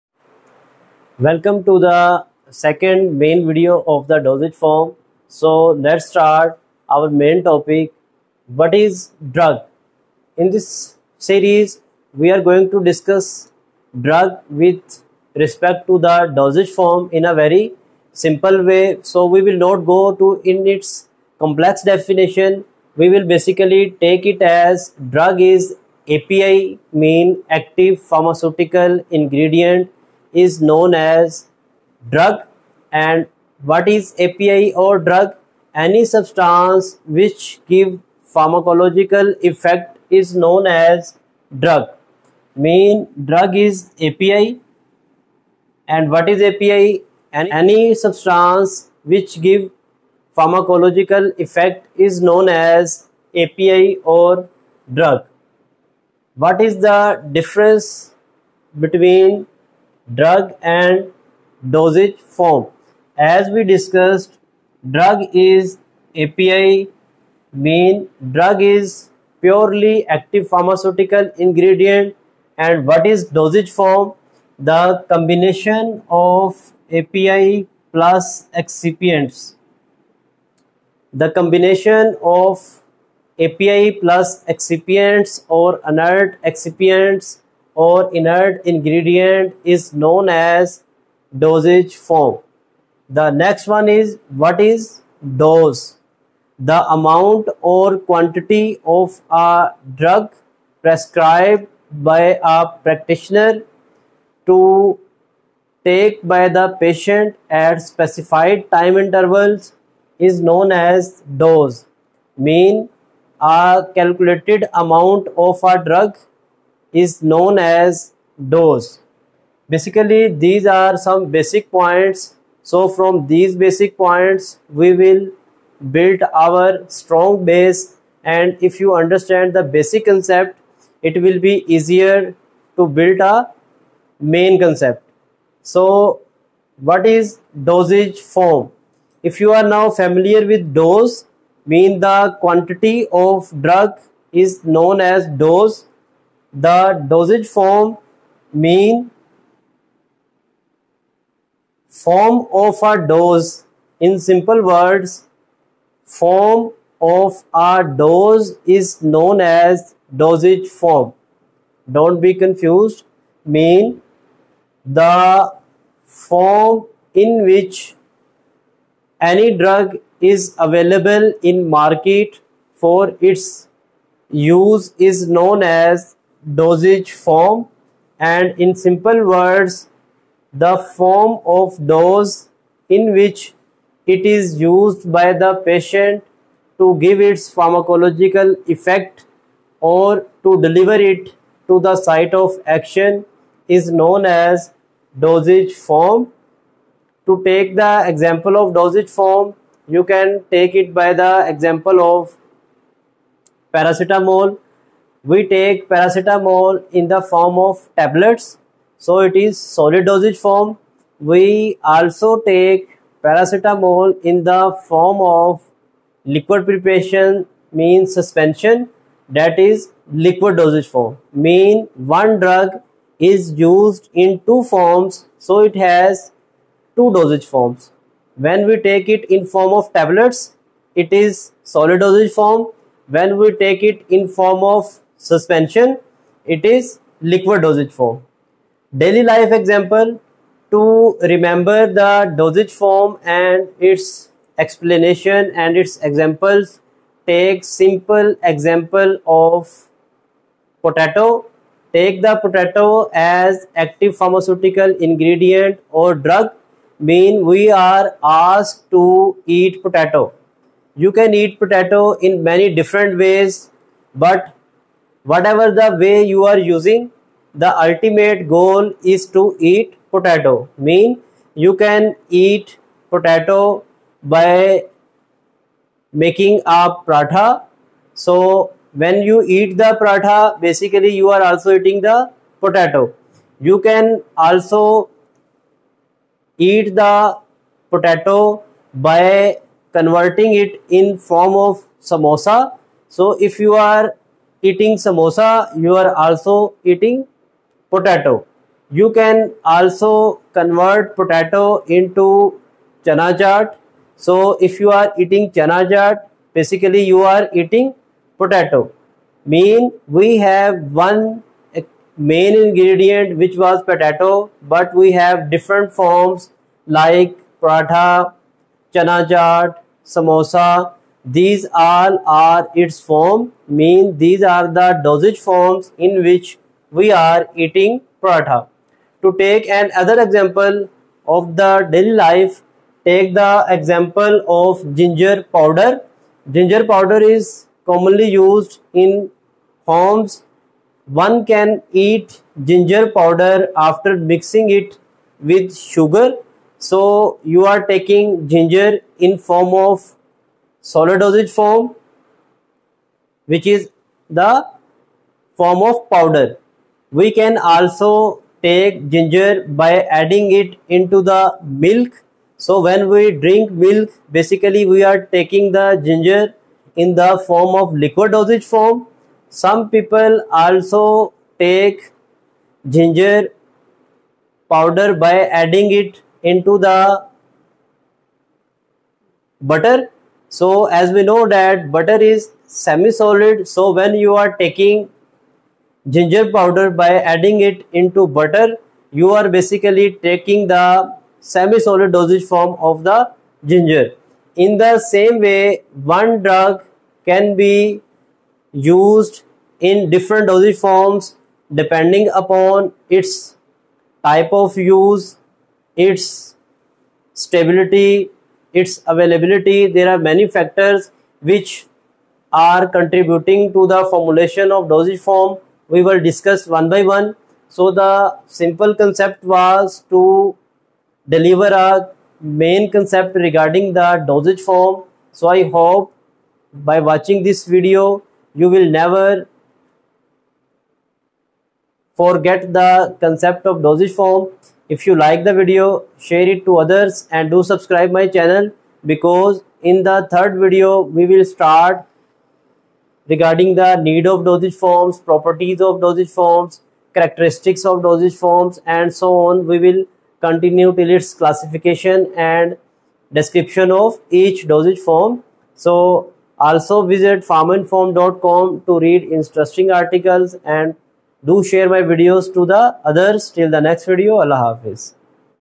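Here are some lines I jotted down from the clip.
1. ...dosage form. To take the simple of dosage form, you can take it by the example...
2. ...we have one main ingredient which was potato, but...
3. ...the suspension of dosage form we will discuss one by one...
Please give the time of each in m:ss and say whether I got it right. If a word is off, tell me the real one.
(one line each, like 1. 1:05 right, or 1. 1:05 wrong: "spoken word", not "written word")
1. 3:15 wrong: "example", not "simple"
2. 5:10 right
3. 6:53 wrong: "formulation", not "suspension".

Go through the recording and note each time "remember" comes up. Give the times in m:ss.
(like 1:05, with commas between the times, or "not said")
4:01.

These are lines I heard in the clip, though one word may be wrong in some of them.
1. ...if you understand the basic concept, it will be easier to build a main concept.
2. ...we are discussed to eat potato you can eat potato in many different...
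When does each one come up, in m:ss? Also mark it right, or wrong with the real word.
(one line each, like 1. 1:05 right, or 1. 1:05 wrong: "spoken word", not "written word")
1. 2:08 right
2. 4:17 wrong: "asked", not "discussed".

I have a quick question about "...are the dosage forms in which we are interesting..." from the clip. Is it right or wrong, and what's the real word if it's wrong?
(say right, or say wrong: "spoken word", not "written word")
wrong: "eating", not "interesting".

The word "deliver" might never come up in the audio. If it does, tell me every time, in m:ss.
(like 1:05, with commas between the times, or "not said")
3:10, 7:01.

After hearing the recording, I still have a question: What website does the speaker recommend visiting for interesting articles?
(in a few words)
pharmainform.com.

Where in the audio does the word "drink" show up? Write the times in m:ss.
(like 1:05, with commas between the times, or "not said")
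6:03.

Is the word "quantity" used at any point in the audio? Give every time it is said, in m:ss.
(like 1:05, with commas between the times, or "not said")
1:37, 2:22.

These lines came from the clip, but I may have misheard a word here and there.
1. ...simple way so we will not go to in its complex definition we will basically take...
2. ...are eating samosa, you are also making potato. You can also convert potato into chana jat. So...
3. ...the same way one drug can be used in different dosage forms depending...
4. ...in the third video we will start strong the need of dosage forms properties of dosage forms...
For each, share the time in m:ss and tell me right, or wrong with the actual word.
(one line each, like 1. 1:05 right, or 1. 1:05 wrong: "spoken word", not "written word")
1. 0:18 right
2. 4:53 wrong: "eating", not "making"
3. 6:34 right
4. 7:19 wrong: "regarding", not "strong".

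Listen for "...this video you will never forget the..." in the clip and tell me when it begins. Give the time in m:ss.
7:07.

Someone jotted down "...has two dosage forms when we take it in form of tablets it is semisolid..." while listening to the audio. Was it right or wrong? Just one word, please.
wrong.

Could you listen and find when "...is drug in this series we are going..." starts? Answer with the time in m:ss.
0:08.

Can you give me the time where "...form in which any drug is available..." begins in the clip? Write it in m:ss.
2:46.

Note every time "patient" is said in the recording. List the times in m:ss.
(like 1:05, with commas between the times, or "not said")
1:46, 3:05.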